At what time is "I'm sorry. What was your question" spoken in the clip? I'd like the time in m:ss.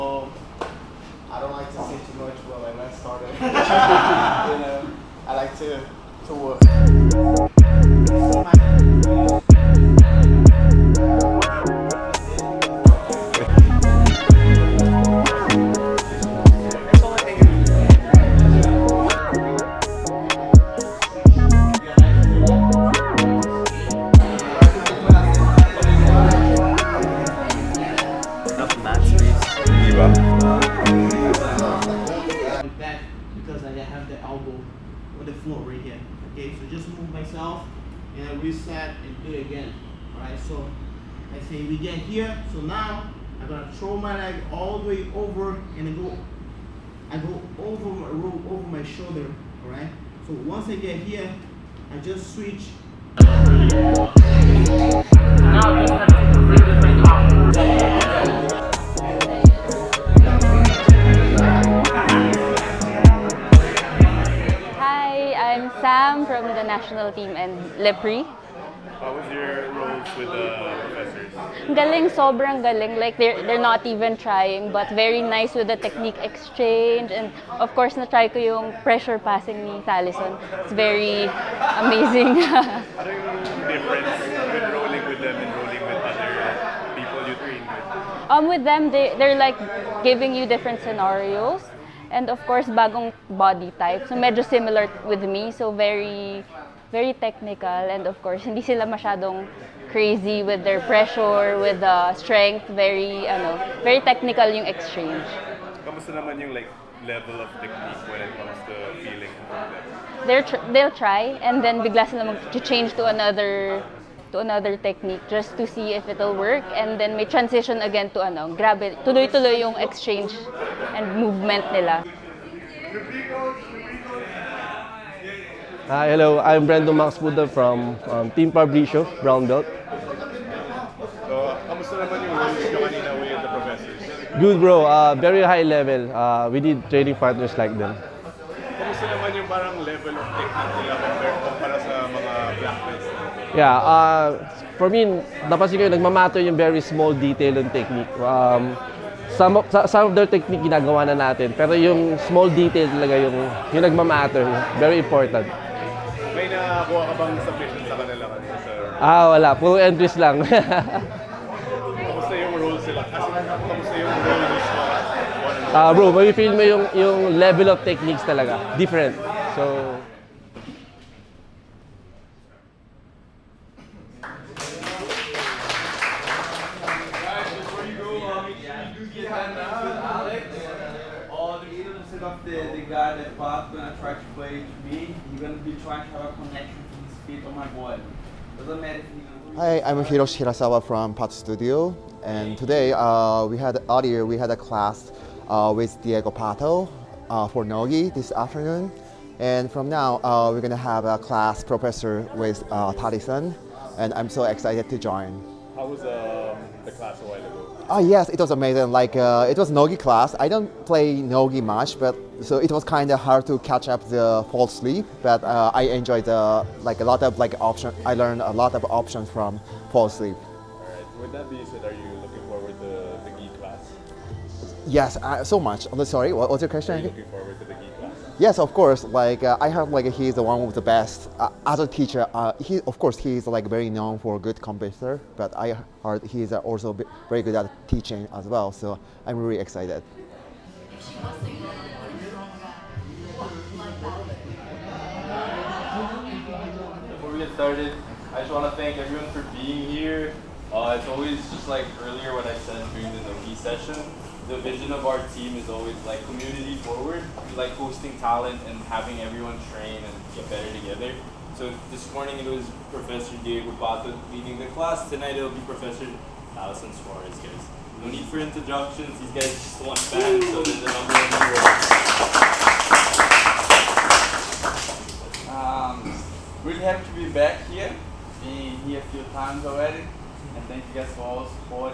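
3:45.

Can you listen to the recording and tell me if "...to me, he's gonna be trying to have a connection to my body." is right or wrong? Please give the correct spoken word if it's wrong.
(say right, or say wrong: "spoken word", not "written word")
right.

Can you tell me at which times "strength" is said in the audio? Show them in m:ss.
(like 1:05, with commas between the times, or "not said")
1:42.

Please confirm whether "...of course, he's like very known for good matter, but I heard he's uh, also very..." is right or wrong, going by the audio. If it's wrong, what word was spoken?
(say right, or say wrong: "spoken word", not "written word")
wrong: "computer", not "matter".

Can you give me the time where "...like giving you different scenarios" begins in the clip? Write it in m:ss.
1:29.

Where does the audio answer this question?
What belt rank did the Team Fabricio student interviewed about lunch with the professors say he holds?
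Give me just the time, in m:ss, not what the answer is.
2:09.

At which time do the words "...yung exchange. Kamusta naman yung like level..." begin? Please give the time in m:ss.
1:44.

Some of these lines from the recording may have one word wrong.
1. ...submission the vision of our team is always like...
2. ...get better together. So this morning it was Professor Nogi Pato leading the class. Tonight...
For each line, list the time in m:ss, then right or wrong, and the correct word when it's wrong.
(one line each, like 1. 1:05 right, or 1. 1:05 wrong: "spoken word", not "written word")
1. 4:13 wrong: "session", not "submission"
2. 4:20 wrong: "Diego", not "Nogi".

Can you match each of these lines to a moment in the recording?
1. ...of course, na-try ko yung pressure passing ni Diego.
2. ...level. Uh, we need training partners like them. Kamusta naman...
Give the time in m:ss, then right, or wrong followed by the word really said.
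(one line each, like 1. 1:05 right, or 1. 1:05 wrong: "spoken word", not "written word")
1. 1:17 wrong: "Thalison", not "Diego"
2. 2:15 right.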